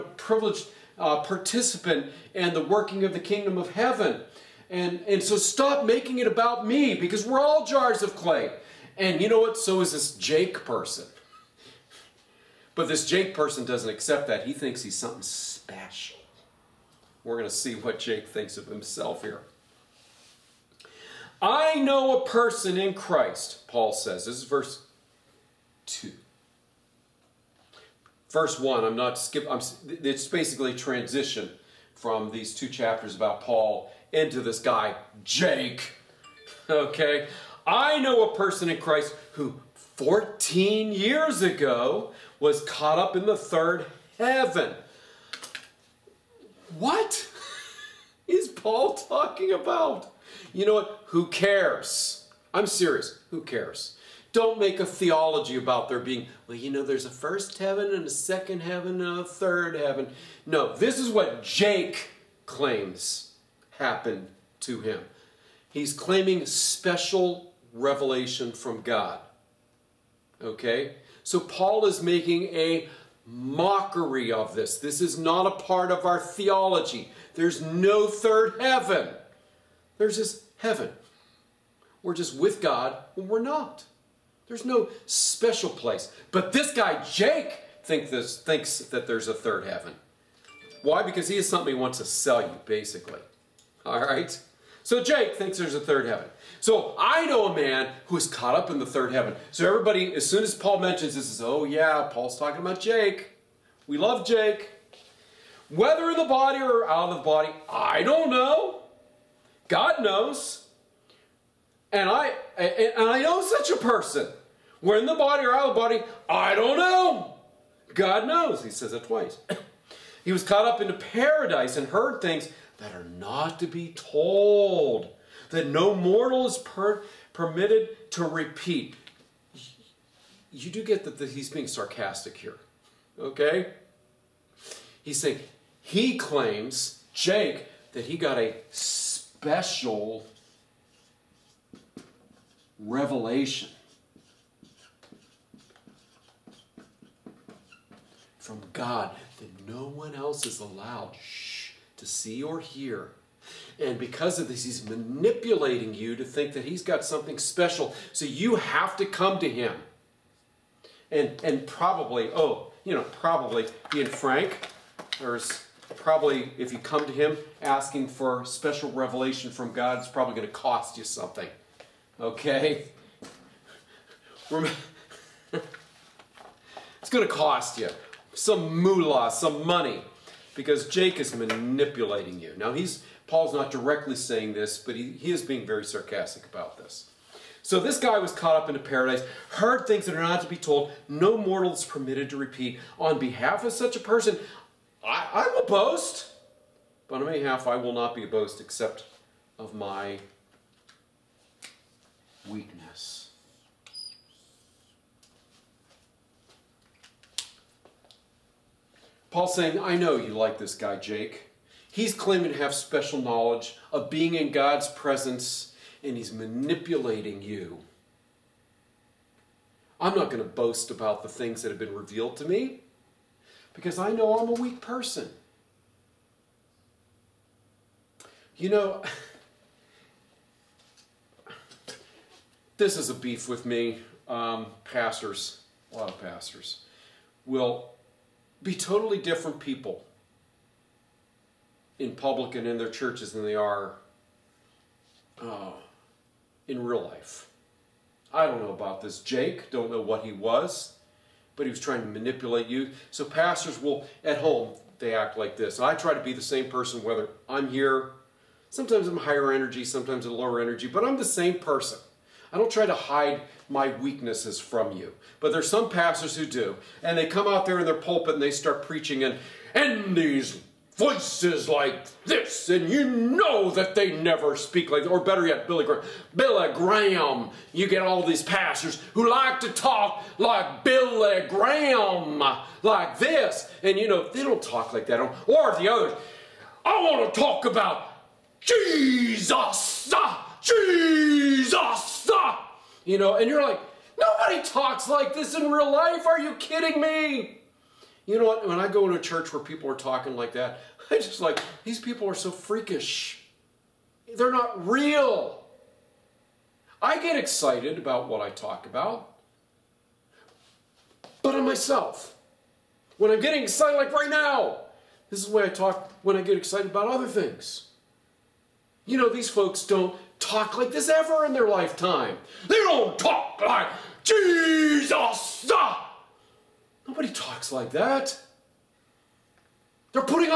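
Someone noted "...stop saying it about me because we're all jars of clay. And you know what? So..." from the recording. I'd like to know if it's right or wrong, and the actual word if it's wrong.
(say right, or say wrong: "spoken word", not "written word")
wrong: "making", not "saying".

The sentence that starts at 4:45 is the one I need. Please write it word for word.
Or the others, I want to talk about Jesus, Jesus stop!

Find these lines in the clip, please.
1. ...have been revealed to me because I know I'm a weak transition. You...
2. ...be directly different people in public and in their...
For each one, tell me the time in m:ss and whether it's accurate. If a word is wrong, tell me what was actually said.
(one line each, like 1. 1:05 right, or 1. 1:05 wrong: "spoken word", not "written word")
1. 3:41 wrong: "person", not "transition"
2. 3:58 wrong: "totally", not "directly".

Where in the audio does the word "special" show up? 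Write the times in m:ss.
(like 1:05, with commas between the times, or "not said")
0:15, 1:06, 1:25, 2:18, 2:37, 2:48, 3:32.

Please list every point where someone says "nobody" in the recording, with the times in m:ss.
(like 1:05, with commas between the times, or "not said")
4:54, 5:27.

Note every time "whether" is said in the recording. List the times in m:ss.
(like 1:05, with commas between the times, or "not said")
1:45, 4:17.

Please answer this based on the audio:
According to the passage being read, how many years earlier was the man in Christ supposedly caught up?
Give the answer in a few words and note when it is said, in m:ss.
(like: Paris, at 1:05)
14, at 0:39.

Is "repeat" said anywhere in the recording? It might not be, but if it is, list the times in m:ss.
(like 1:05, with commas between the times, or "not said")
2:08, 3:12.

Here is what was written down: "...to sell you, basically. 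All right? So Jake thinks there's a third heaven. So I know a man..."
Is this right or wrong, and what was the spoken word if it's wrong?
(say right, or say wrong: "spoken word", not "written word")
right.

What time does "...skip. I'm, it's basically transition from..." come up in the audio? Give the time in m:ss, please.
0:29.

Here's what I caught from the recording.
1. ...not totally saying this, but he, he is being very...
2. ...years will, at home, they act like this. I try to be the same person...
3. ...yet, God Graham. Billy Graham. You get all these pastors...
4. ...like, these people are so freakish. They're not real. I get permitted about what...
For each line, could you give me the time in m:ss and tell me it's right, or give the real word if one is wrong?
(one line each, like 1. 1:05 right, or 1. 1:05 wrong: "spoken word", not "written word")
1. 3:03 wrong: "directly", not "totally"
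2. 4:13 wrong: "pastors", not "years"
3. 4:35 wrong: "Billy", not "God"
4. 5:01 wrong: "excited", not "permitted".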